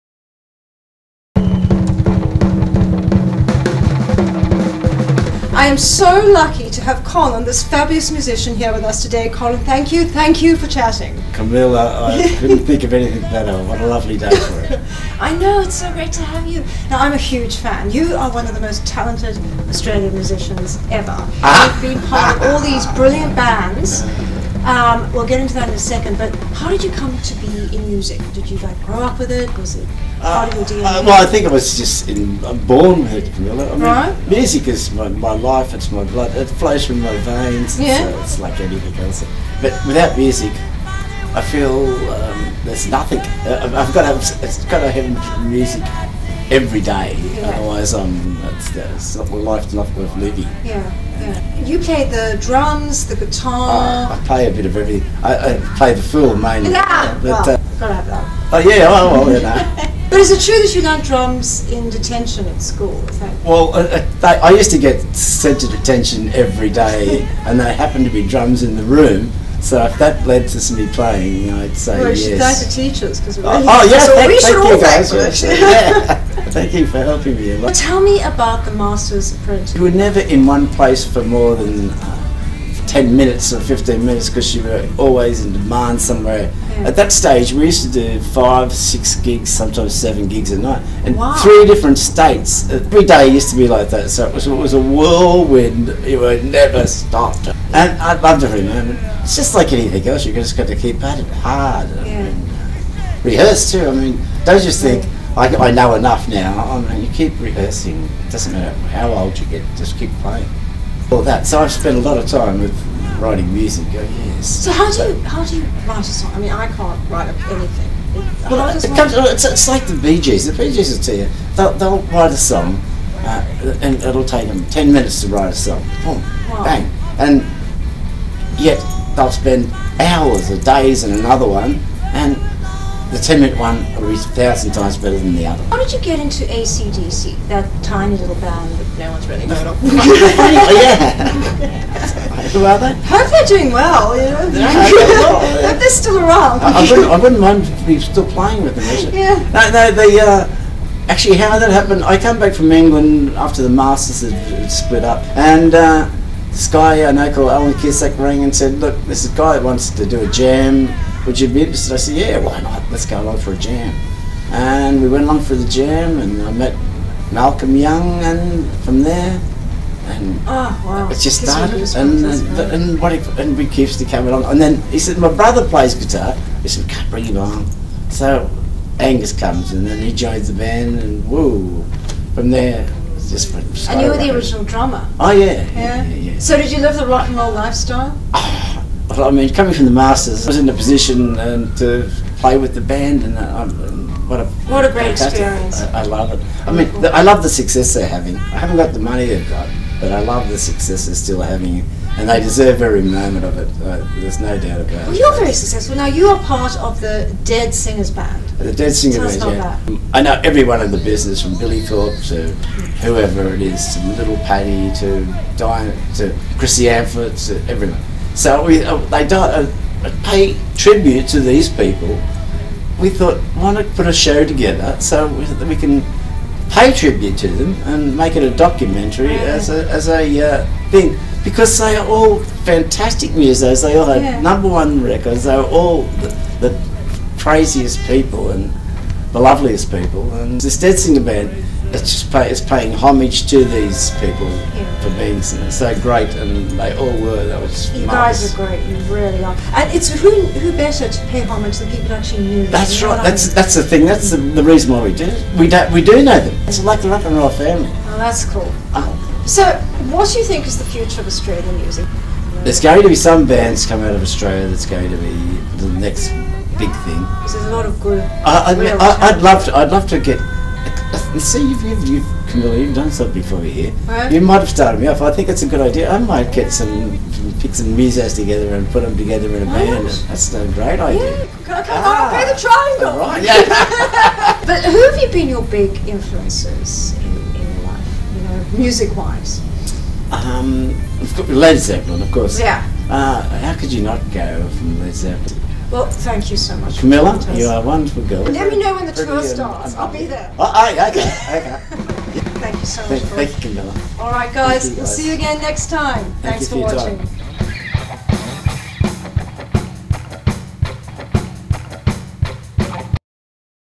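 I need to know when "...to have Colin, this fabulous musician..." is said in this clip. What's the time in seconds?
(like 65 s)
6 s.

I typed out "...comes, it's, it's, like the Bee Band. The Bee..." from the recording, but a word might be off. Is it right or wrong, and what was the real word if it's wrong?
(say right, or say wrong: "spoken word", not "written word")
wrong: "Gees", not "Band".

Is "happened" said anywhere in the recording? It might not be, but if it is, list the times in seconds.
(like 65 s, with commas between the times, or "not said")
67 s, 151 s.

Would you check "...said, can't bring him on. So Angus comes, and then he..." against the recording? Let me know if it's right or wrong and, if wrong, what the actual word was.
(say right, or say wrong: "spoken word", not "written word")
right.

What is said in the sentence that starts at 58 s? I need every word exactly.
Oh yeah, oh, well, you know.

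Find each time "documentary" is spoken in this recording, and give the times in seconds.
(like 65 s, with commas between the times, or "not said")
228 s.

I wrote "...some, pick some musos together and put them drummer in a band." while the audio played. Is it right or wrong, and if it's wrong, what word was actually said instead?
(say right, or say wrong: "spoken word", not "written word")
wrong: "together", not "drummer".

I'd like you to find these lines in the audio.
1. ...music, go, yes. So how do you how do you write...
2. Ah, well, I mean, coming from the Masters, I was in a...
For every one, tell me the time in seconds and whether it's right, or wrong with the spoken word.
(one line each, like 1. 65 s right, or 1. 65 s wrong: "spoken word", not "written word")
1. 113 s right
2. 188 s right.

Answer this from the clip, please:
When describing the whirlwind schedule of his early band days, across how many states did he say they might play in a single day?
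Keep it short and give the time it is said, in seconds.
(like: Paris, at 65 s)
3, at 91 s.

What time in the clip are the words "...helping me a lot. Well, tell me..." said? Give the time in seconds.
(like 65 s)
76 s.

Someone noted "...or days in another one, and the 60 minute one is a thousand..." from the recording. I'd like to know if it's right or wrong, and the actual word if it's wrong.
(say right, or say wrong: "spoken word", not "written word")
wrong: "10", not "60".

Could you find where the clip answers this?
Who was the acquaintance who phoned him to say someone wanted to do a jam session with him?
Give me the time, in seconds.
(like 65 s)
157 s.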